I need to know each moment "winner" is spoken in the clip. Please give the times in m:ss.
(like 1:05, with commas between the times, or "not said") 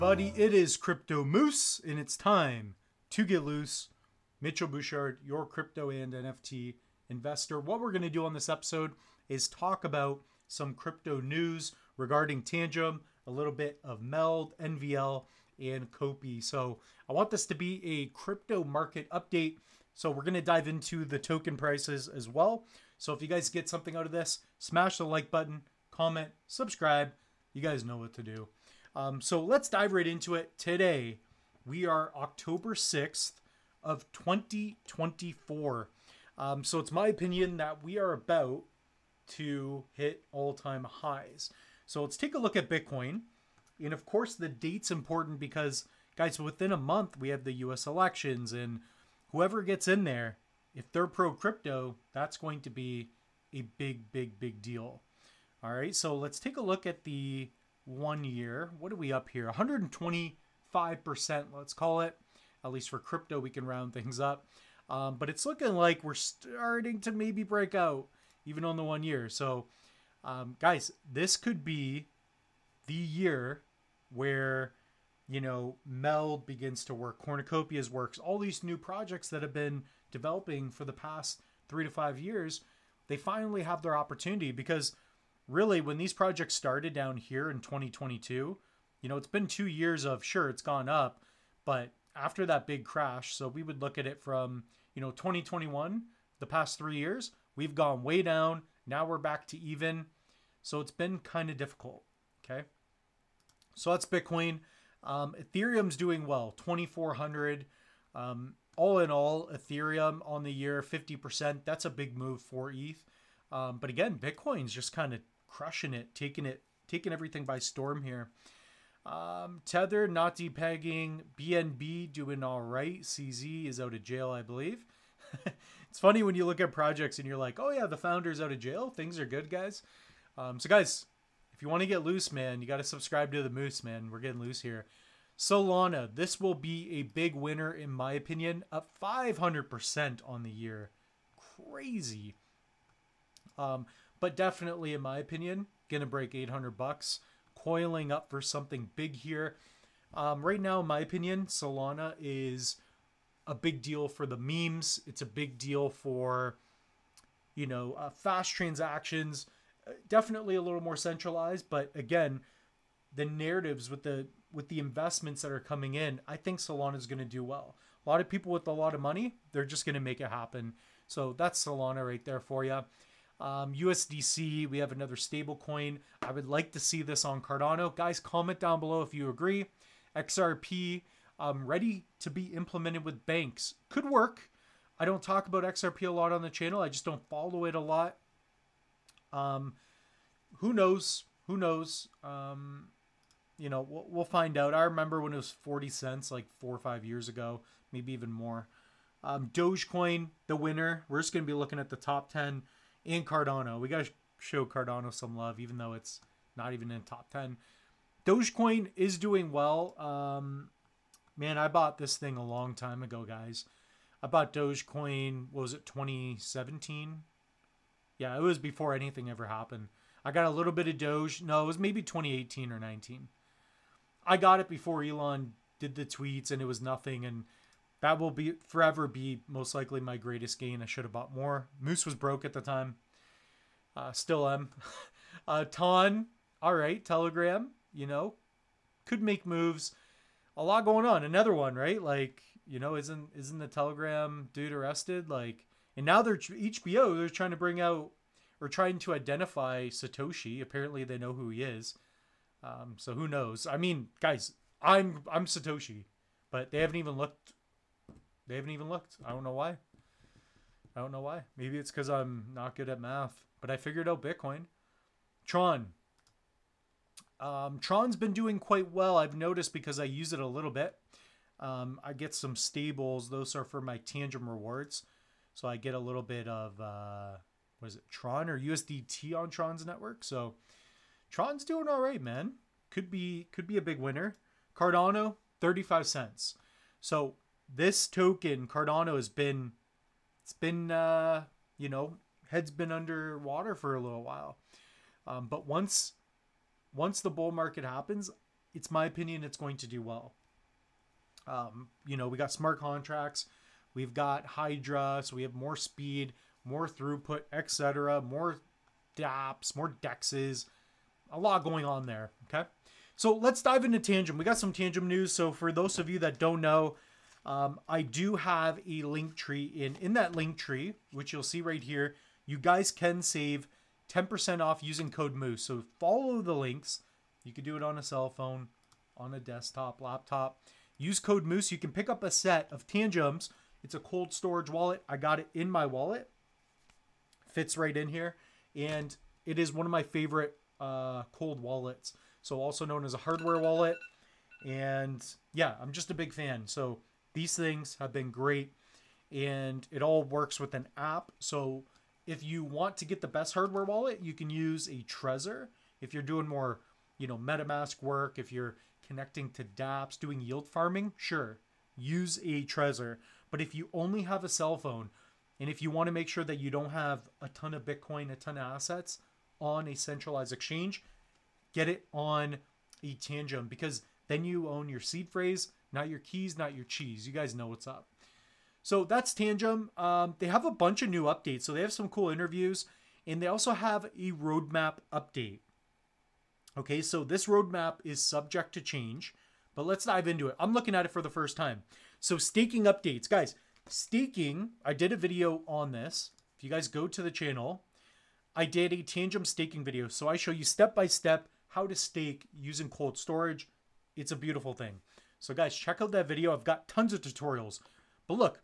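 2:17, 3:20, 4:43.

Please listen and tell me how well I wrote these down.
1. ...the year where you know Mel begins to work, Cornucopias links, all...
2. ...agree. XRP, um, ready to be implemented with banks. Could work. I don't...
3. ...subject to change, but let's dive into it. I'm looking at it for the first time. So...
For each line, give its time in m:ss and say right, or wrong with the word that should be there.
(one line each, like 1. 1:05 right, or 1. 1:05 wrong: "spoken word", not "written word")
1. 1:12 wrong: "works", not "links"
2. 2:59 right
3. 6:28 right.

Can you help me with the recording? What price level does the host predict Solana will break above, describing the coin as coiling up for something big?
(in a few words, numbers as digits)
$800.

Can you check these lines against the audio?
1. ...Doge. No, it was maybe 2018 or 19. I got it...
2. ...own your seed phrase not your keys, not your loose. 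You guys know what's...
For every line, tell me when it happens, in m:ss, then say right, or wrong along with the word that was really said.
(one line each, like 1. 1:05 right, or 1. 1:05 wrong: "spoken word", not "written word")
1. 3:40 right
2. 6:14 wrong: "cheese", not "loose".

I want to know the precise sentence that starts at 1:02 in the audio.
At least for crypto, we can round things up.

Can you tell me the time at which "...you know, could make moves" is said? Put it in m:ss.
3:57.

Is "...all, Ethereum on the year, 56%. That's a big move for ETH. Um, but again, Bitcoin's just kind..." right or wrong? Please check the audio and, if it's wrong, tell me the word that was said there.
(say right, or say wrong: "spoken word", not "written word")
wrong: "50", not "56".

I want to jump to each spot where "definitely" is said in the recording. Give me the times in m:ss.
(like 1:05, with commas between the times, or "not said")
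2:24, 2:40.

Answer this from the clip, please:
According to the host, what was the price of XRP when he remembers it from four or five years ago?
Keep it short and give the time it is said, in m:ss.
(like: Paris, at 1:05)
40 cents, at 3:15.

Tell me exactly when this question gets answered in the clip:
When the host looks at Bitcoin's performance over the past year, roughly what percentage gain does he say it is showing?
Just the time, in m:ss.
0:59.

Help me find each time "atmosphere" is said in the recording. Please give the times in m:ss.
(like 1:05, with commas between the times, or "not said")
not said.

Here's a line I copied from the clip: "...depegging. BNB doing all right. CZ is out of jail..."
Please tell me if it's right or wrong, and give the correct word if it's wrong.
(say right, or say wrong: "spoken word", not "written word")
right.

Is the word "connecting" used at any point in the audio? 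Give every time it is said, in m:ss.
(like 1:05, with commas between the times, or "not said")
5:59.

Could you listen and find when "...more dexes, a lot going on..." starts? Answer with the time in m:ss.
5:09.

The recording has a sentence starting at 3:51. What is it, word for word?
Moose was broke at the time.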